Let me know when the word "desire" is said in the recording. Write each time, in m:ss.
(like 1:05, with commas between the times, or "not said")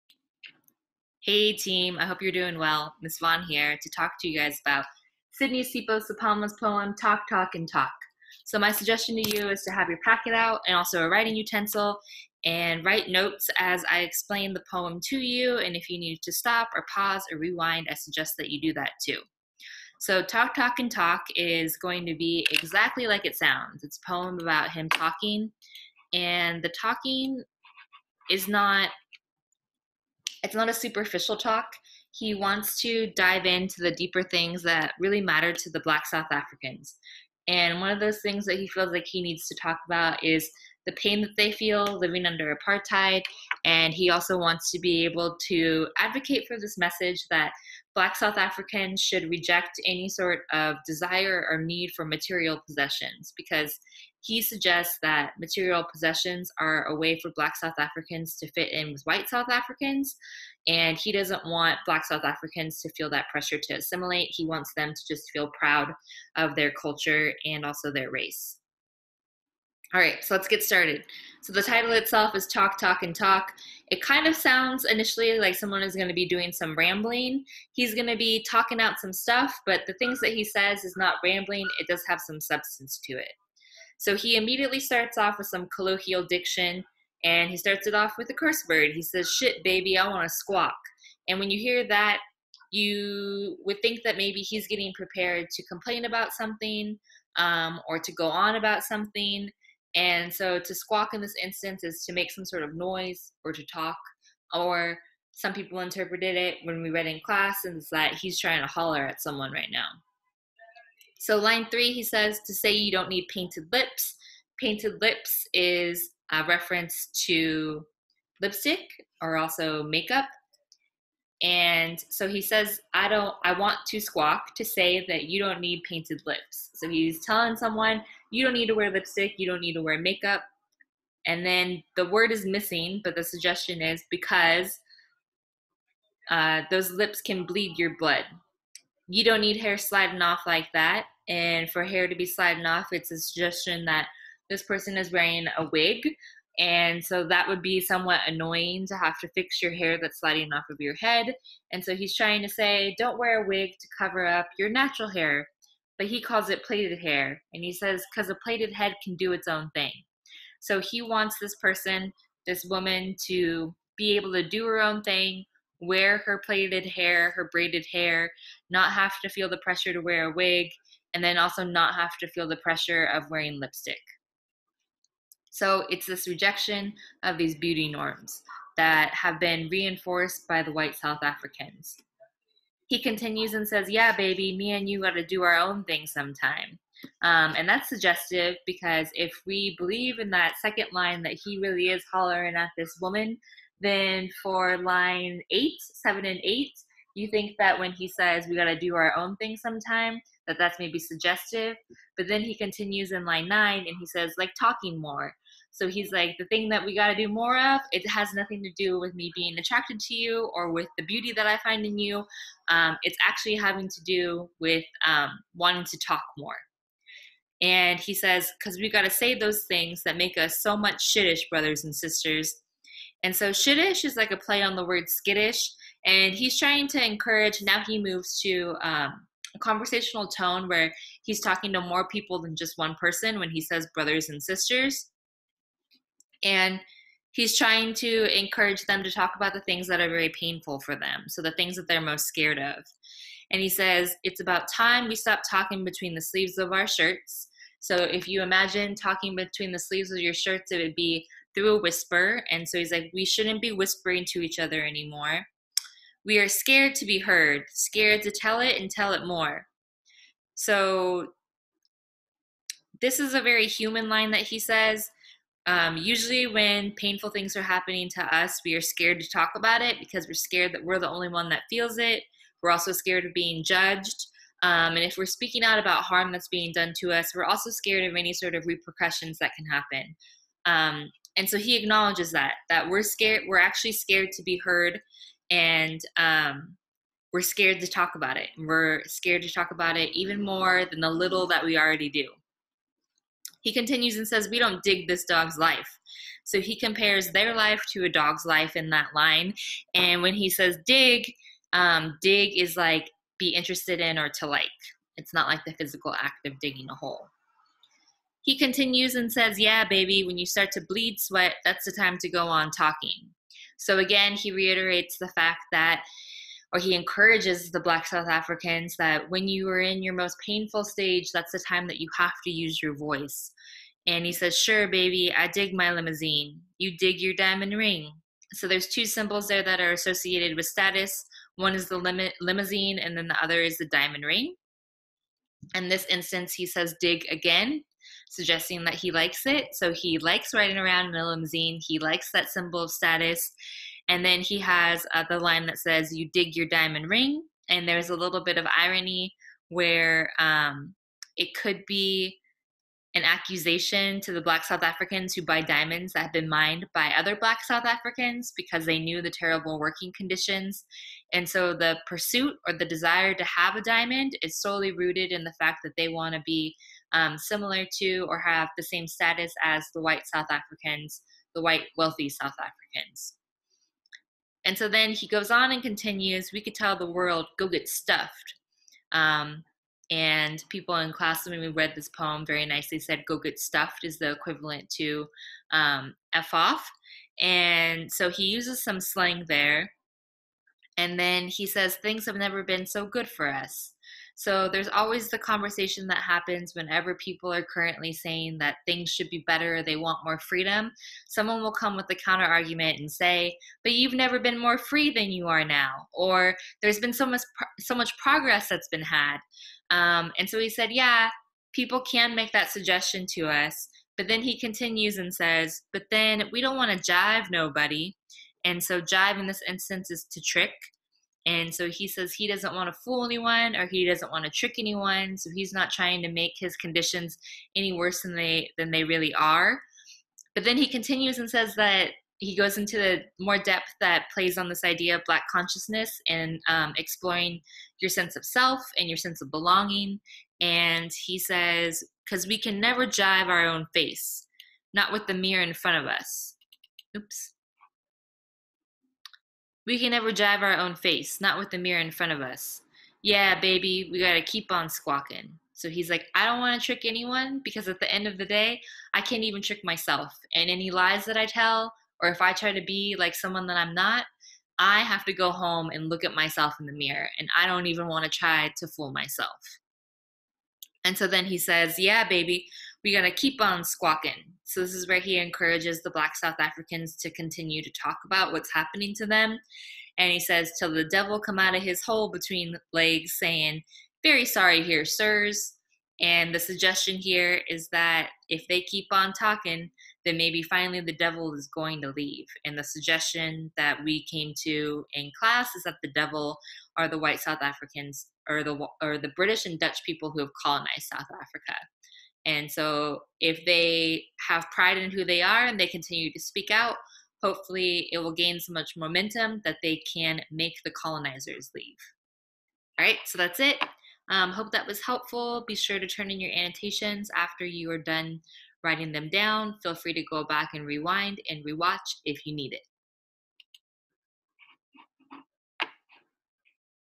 0:50, 6:02.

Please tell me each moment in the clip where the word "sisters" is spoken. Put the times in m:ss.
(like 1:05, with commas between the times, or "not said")
3:41, 3:54.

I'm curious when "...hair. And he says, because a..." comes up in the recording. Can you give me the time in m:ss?
2:36.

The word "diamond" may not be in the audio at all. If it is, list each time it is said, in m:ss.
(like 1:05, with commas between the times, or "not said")
5:27, 5:33, 5:46, 5:55, 6:03.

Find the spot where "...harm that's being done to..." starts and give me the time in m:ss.
4:36.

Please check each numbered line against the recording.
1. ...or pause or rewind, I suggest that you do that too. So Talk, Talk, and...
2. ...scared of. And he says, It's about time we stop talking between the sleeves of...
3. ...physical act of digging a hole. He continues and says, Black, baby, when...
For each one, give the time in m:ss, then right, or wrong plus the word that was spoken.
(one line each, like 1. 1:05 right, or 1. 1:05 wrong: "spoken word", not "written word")
1. 0:16 right
2. 4:02 right
3. 5:05 wrong: "Yeah", not "Black".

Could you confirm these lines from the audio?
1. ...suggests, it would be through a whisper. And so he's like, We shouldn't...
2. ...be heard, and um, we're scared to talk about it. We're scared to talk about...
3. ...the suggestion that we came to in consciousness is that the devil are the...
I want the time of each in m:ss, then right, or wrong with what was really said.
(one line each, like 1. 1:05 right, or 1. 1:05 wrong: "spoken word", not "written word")
1. 4:10 wrong: "shirts", not "suggests"
2. 4:44 right
3. 8:12 wrong: "class", not "consciousness".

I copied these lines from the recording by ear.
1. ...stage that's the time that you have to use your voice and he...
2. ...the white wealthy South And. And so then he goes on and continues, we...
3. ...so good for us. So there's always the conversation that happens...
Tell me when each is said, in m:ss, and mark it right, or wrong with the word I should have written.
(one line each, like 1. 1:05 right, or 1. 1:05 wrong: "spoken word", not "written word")
1. 5:20 right
2. 6:11 wrong: "Africans", not "And"
3. 6:32 right.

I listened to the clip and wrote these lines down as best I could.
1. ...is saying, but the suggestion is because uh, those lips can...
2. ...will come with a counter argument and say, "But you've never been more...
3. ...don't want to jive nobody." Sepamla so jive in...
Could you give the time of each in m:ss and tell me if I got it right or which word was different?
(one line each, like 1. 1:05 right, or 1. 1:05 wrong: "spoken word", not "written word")
1. 2:12 wrong: "missing", not "saying"
2. 6:41 right
3. 6:56 wrong: "And", not "Sepamla".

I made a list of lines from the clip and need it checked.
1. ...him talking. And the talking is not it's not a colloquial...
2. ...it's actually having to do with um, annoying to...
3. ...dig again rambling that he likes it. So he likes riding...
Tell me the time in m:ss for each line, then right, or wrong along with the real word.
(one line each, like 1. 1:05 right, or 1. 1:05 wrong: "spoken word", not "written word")
1. 0:24 wrong: "superficial", not "colloquial"
2. 3:33 wrong: "wanting", not "annoying"
3. 5:37 wrong: "suggesting", not "rambling".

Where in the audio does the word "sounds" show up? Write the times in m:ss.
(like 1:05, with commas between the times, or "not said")
0:23, 1:14.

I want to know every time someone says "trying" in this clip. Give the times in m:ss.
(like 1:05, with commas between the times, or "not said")
1:48, 2:32, 3:46, 3:57, 7:05.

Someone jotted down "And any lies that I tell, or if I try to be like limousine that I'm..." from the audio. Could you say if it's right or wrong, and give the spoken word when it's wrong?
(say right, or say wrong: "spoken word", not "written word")
wrong: "someone", not "limousine".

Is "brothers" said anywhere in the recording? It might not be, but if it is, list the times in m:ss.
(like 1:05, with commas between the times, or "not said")
3:41, 3:53.